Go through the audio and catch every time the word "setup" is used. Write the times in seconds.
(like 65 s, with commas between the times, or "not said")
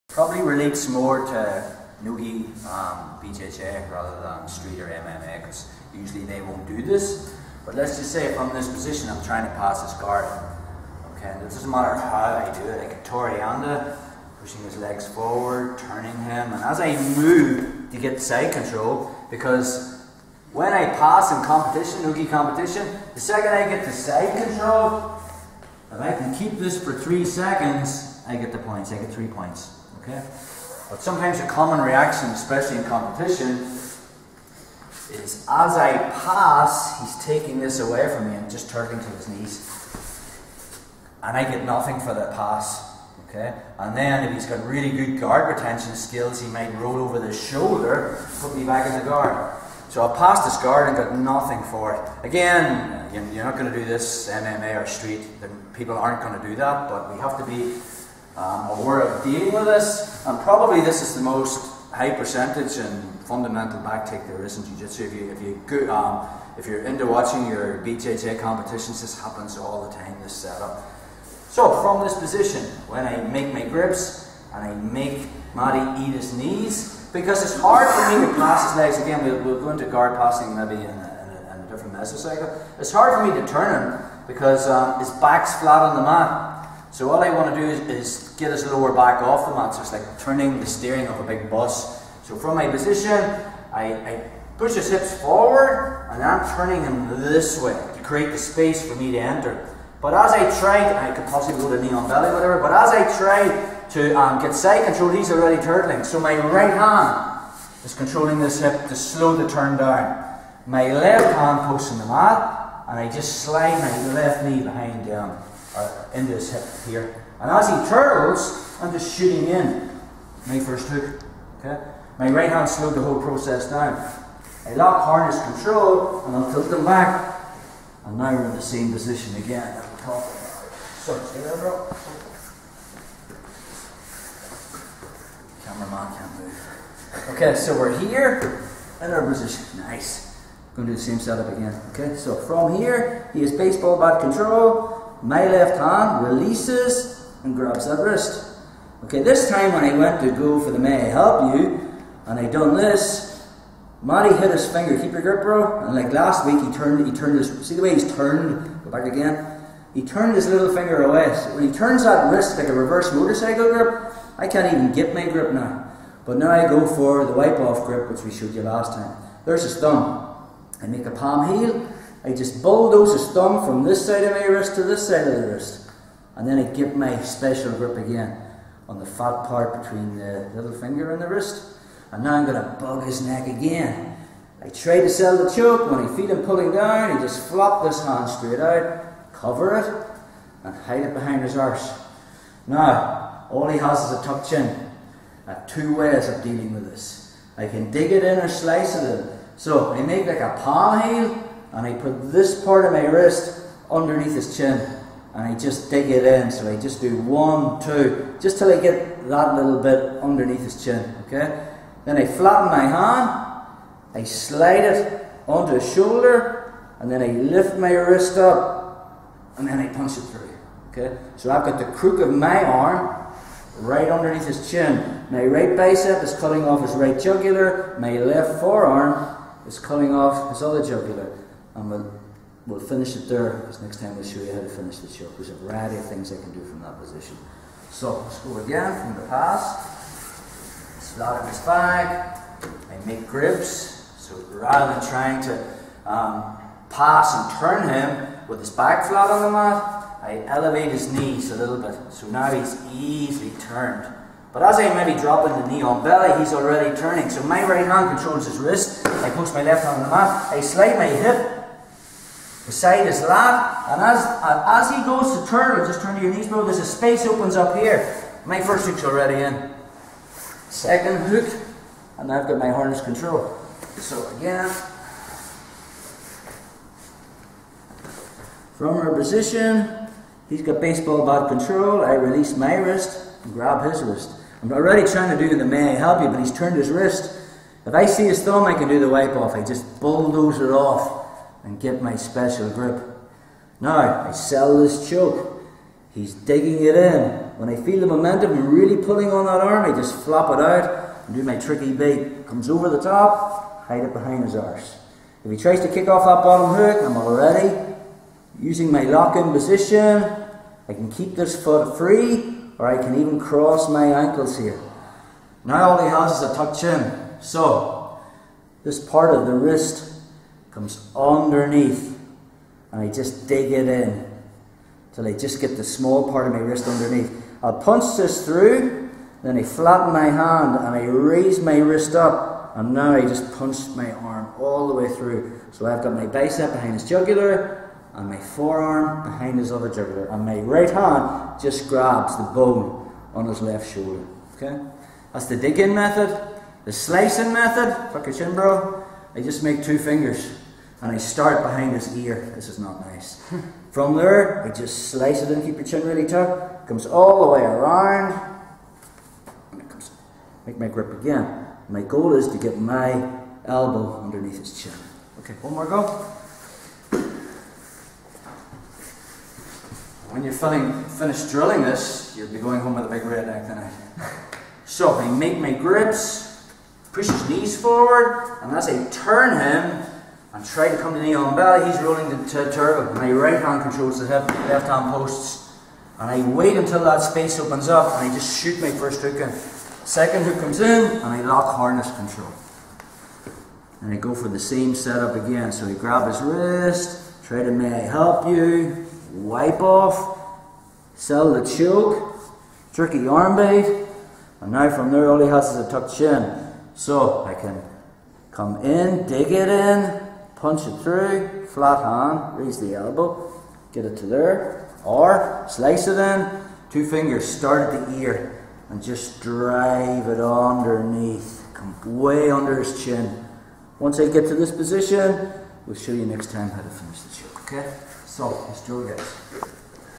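70 s, 141 s, 394 s.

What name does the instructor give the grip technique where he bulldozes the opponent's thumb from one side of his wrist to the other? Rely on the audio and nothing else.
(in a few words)
Wipe off grip.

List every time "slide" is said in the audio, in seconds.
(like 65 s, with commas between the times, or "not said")
113 s, 214 s, 260 s.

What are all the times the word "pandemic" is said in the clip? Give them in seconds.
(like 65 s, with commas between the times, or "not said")
not said.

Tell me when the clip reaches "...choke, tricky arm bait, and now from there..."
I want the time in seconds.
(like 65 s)
401 s.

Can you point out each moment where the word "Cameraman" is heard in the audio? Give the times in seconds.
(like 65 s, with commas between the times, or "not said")
135 s.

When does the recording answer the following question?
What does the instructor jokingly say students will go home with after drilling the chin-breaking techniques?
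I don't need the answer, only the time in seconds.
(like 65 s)
373 s.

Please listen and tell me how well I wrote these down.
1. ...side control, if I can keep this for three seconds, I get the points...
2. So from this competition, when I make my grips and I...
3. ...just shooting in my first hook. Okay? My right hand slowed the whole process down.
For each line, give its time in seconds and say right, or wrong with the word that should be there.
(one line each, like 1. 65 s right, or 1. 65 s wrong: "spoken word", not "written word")
1. 23 s right
2. 71 s wrong: "position", not "competition"
3. 118 s right.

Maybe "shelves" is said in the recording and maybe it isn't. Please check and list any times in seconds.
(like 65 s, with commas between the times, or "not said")
not said.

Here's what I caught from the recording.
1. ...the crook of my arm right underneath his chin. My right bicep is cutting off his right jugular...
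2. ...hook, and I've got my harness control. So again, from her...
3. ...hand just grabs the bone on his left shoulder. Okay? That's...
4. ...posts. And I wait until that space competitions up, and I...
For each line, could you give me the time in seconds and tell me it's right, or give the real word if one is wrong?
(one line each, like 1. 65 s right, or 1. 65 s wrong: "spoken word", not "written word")
1. 221 s right
2. 271 s right
3. 340 s right
4. 385 s wrong: "opens", not "competitions".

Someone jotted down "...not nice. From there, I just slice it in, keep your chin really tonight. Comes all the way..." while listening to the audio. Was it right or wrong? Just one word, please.
wrong.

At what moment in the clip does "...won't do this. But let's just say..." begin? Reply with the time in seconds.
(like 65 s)
6 s.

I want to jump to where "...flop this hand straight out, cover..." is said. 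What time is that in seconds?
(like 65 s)
187 s.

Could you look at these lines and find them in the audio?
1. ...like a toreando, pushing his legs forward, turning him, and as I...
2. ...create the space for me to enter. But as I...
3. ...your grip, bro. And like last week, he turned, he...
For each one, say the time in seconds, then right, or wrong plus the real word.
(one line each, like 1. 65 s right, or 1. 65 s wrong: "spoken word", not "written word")
1. 12 s right
2. 98 s right
3. 155 s right.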